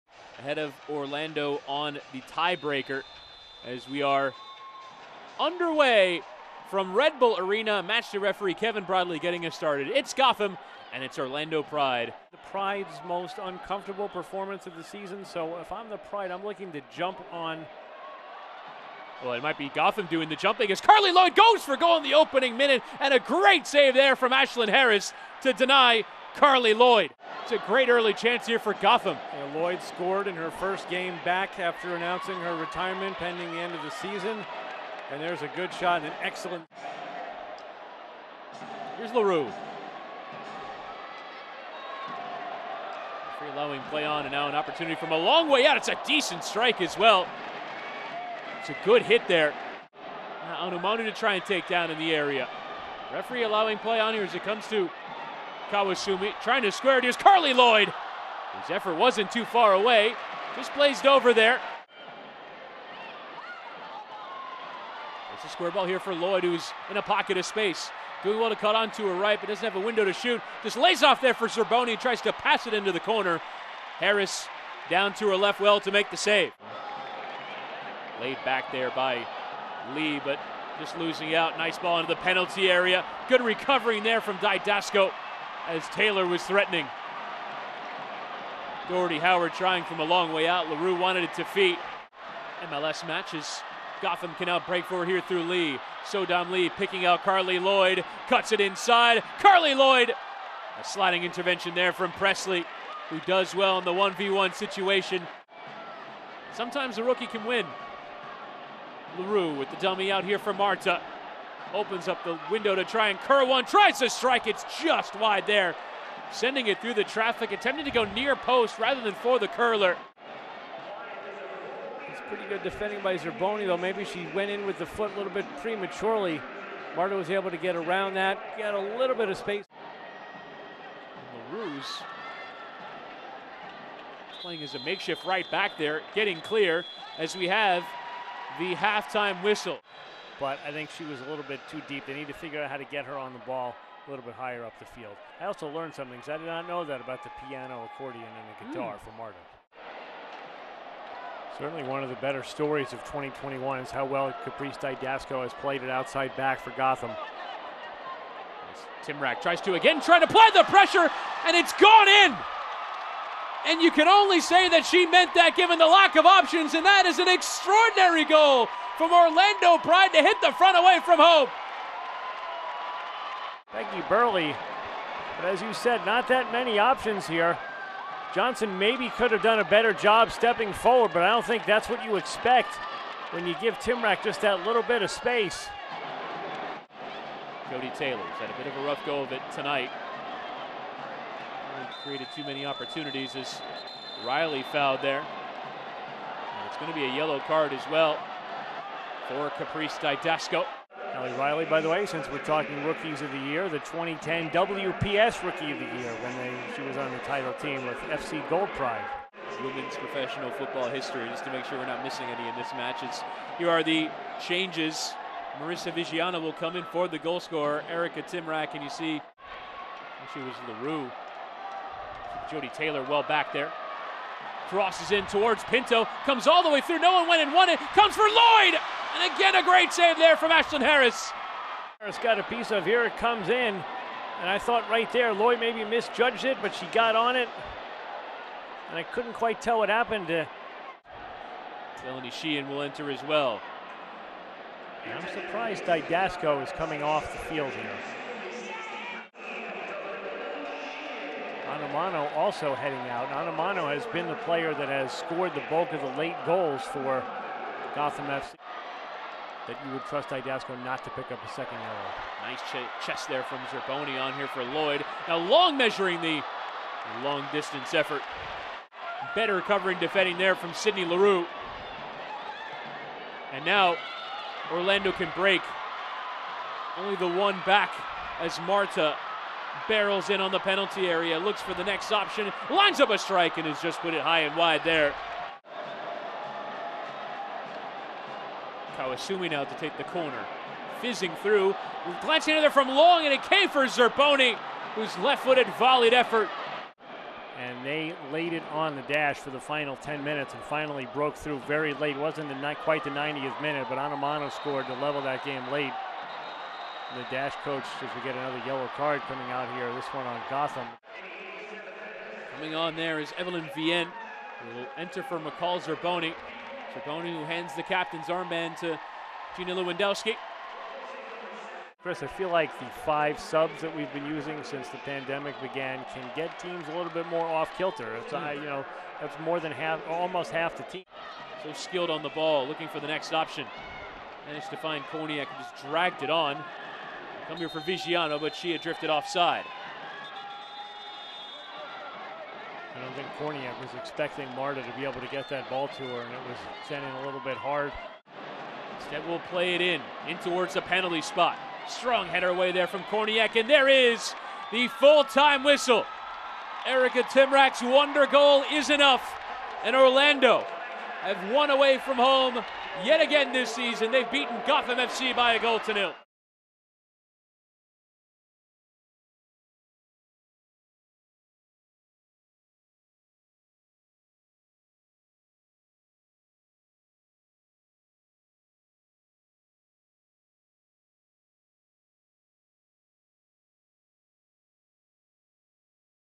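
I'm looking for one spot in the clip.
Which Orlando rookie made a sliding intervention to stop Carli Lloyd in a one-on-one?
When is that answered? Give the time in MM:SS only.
01:42.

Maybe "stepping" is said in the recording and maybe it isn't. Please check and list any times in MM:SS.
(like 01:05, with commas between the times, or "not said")
03:00.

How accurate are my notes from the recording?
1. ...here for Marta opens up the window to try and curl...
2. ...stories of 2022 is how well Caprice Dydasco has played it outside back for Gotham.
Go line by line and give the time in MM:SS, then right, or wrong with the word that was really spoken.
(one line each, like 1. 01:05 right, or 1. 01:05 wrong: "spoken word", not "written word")
1. 01:50 right
2. 02:32 wrong: "2021", not "2022".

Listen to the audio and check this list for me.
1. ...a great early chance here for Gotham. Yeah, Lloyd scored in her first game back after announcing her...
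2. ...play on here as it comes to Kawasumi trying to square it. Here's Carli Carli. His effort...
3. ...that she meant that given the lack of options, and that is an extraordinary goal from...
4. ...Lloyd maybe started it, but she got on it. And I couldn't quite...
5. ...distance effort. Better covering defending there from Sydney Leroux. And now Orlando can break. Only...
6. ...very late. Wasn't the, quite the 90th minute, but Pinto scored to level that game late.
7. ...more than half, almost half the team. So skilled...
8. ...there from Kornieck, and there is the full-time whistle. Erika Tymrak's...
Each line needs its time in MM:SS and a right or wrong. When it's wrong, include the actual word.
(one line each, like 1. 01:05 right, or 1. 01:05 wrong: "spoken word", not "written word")
1. 00:27 right
2. 00:53 wrong: "Lloyd", not "Carli"
3. 02:44 right
4. 03:55 wrong: "misjudged", not "started"
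5. 04:27 right
6. 05:01 wrong: "Onumonu", not "Pinto"
7. 05:29 right
8. 05:52 right.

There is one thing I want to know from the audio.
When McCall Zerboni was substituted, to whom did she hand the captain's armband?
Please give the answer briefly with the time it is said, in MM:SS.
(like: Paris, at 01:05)
Gina Lewandowski, at 05:19.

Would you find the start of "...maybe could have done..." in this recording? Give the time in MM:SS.
02:58.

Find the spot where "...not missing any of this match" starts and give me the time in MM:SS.
03:31.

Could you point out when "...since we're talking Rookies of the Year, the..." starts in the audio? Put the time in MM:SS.
03:22.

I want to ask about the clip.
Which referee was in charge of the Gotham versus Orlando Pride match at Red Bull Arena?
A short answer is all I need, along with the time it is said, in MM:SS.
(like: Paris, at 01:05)
Kevin Bradley, at 00:08.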